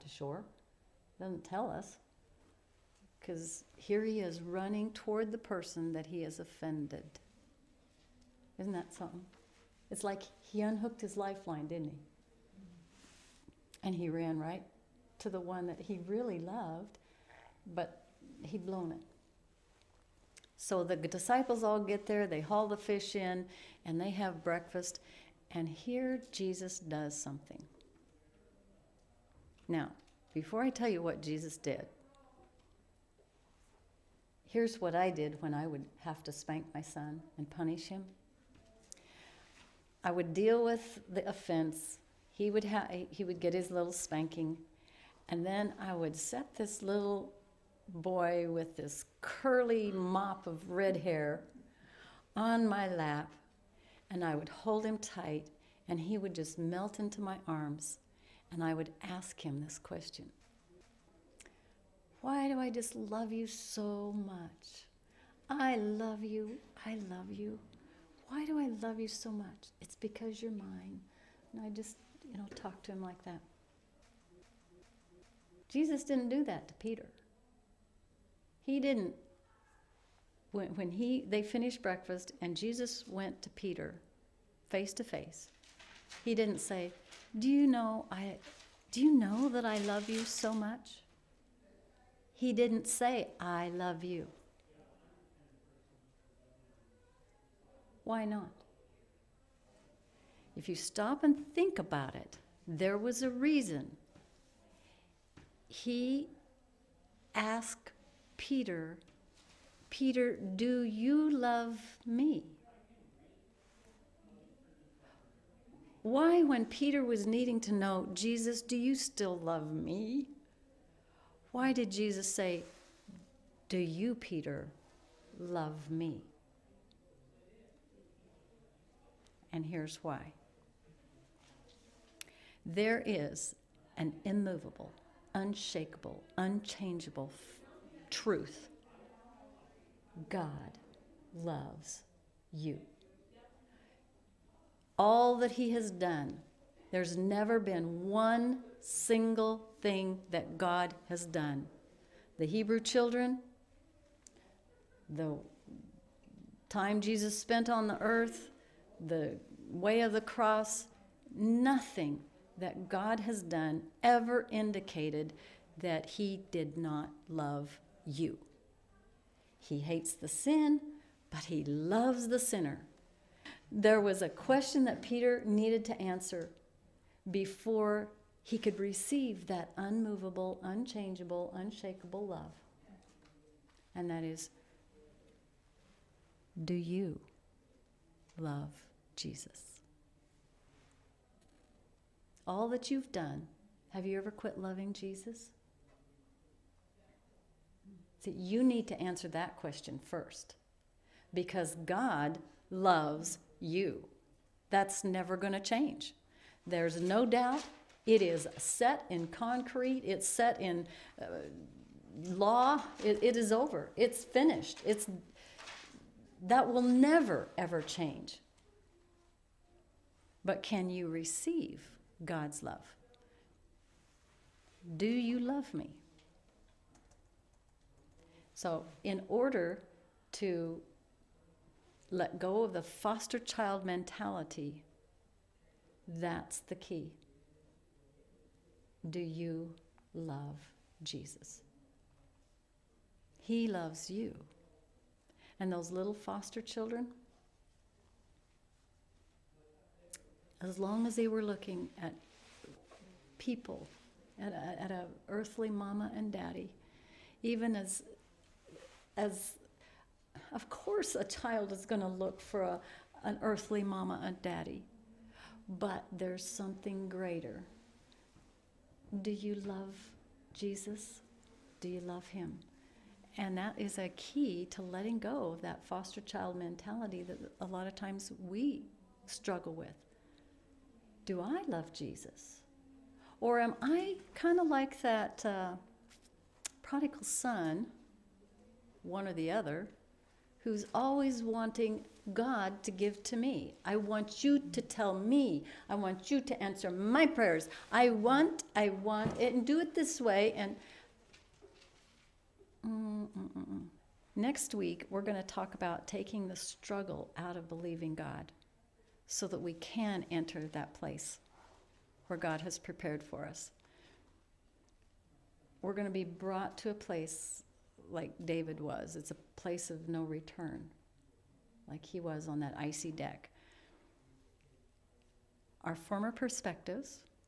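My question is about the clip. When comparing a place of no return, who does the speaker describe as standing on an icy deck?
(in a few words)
David.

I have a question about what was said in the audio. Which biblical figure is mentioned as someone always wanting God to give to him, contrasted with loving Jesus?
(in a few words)
prodigal son.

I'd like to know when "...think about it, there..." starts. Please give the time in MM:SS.
01:41.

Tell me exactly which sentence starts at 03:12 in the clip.
all that you've done, have you ever quit loving Jesus?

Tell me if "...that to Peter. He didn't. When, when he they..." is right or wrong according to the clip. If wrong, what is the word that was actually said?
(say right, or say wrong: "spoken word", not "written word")
right.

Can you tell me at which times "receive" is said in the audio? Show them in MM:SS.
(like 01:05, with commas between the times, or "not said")
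02:58, 03:41.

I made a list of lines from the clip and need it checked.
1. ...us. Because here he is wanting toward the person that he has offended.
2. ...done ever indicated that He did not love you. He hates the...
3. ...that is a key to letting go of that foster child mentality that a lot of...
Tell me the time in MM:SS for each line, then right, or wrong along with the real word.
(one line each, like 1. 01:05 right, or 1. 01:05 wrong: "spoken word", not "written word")
1. 00:01 wrong: "running", not "wanting"
2. 02:43 right
3. 04:33 right.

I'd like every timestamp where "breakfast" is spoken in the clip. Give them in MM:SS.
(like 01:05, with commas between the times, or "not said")
00:24, 01:21.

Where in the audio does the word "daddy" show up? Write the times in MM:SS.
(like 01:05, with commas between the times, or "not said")
04:16, 04:24.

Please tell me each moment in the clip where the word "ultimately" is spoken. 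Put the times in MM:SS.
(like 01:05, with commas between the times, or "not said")
not said.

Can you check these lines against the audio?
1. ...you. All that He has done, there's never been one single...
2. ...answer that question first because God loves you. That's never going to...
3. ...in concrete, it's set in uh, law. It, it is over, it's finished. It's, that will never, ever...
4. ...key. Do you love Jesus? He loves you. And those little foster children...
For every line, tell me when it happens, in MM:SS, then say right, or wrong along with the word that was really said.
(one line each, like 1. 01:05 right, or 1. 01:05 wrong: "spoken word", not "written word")
1. 02:22 right
2. 03:19 right
3. 03:29 right
4. 03:56 right.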